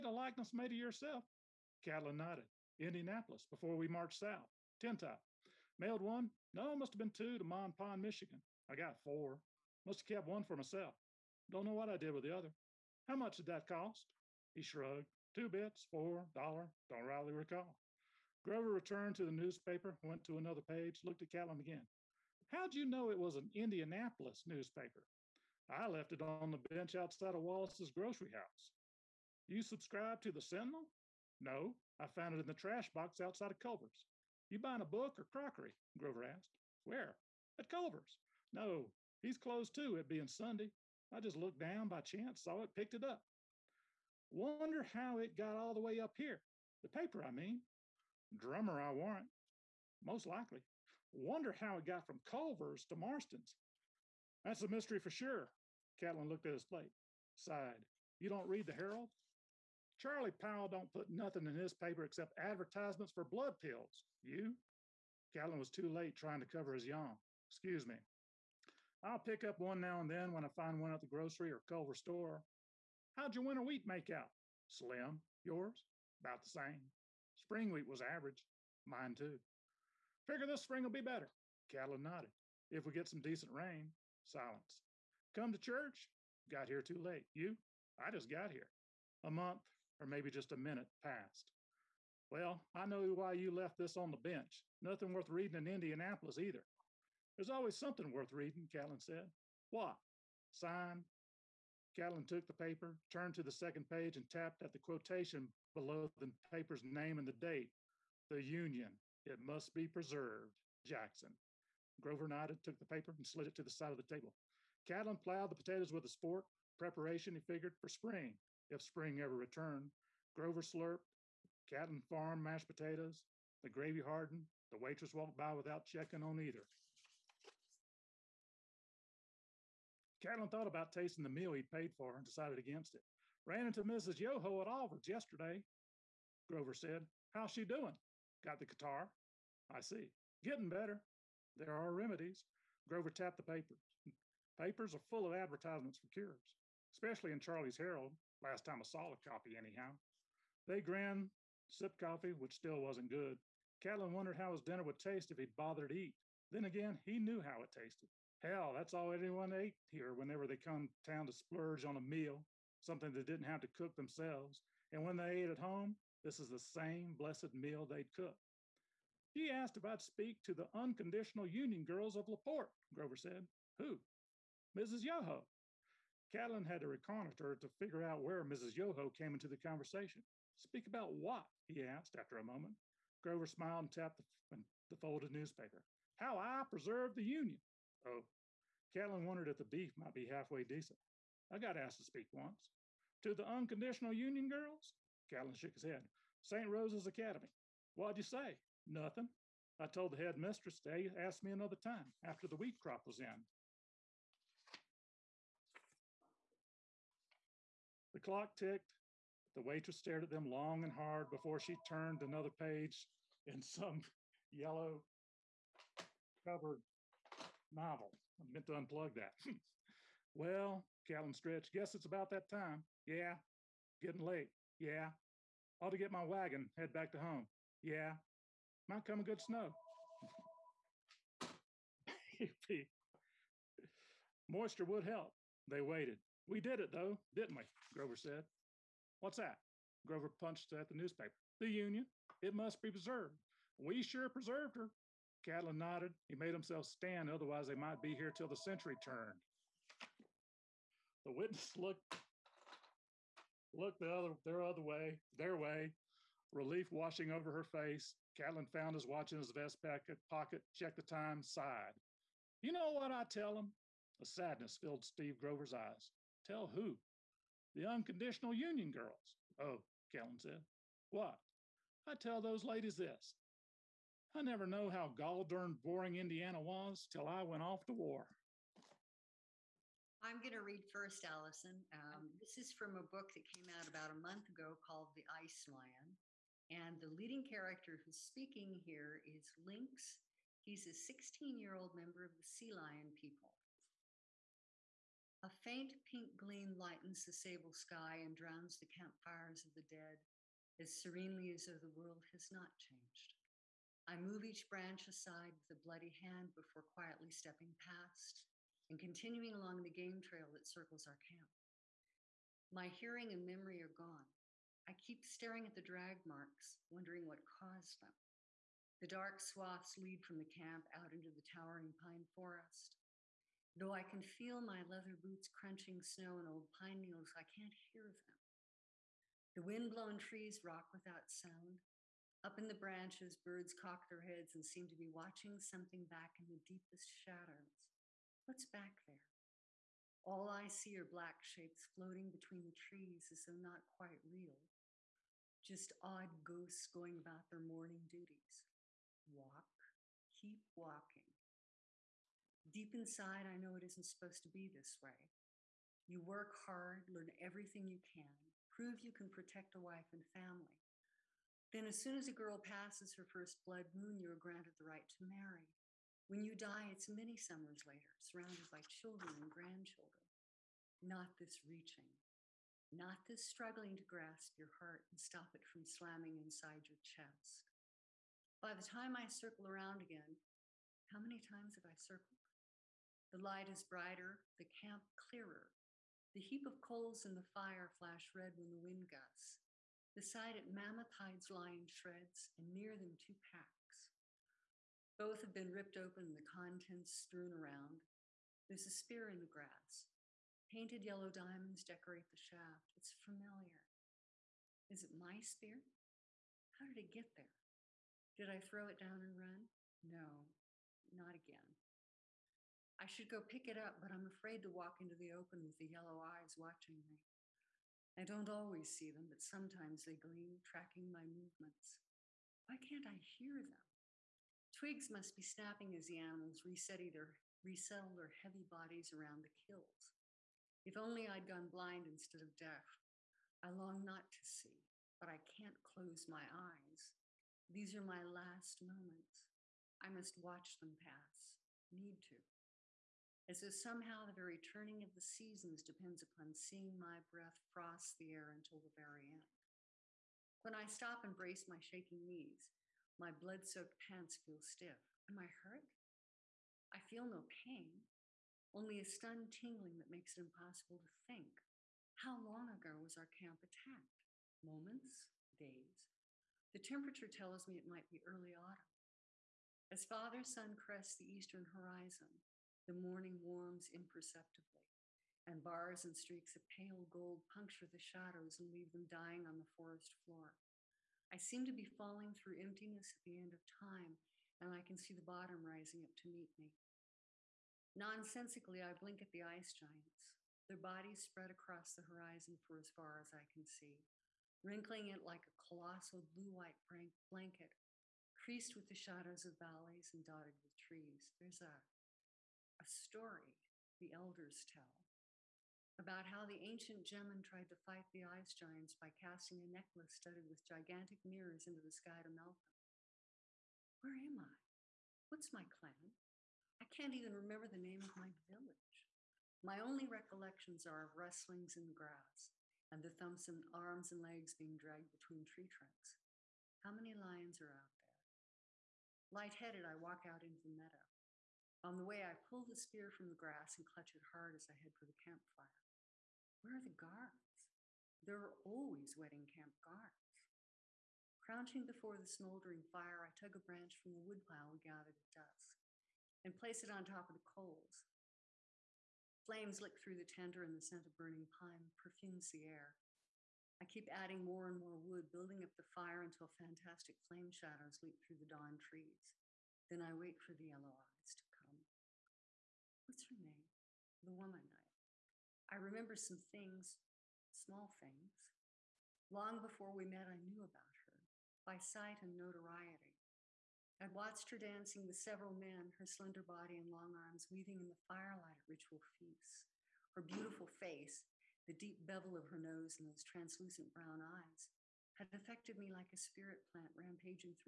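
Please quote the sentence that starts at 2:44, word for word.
And when they ate at home, this is the same blessed meal they'd cook.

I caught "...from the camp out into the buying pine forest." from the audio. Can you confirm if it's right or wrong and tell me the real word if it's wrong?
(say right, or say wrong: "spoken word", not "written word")
wrong: "towering", not "buying".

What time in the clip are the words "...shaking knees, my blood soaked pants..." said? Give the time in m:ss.
7:31.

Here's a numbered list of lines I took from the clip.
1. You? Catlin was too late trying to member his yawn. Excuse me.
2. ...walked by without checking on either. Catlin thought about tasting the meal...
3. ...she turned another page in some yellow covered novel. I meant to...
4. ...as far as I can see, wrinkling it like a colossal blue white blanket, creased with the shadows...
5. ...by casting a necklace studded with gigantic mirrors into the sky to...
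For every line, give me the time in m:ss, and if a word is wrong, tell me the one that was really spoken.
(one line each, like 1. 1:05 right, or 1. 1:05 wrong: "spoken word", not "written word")
1. 1:04 wrong: "cover", not "member"
2. 2:05 right
3. 3:31 right
4. 8:12 right
5. 8:28 right.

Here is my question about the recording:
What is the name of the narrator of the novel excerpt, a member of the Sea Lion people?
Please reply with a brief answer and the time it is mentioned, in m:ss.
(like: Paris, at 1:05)
Lynx, at 4:49.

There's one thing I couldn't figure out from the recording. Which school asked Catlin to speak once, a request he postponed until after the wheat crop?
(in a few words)
St. Rose's Academy.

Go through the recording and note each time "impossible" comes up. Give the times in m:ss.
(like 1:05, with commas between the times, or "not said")
7:40.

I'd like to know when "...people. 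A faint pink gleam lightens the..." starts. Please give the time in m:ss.
4:53.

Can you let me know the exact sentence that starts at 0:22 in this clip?
How'd you know it was an Indianapolis newspaper?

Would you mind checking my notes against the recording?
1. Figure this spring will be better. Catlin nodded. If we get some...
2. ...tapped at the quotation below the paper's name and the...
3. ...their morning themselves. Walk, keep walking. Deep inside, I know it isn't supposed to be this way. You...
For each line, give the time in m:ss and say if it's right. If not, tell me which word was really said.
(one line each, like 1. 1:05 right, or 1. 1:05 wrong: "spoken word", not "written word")
1. 1:20 right
2. 1:44 right
3. 5:47 wrong: "duties", not "themselves".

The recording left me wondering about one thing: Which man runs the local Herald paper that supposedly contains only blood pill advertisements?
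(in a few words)
Charlie Powell.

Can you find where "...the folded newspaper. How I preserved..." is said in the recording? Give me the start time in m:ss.
3:04.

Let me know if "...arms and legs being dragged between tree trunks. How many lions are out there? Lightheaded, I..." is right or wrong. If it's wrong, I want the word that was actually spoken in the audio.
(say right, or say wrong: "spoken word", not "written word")
right.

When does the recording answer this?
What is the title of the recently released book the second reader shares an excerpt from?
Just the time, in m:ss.
4:45.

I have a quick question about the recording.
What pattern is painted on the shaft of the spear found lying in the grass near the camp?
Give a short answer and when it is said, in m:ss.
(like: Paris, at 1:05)
yellow diamonds, at 6:41.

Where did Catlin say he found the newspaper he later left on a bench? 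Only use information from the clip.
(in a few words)
trash box outside of Culver's.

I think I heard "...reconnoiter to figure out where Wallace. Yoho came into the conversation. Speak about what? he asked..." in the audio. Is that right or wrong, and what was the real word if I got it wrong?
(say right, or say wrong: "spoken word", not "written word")
wrong: "Mrs", not "Wallace".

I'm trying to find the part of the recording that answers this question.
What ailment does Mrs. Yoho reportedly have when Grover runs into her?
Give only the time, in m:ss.
2:18.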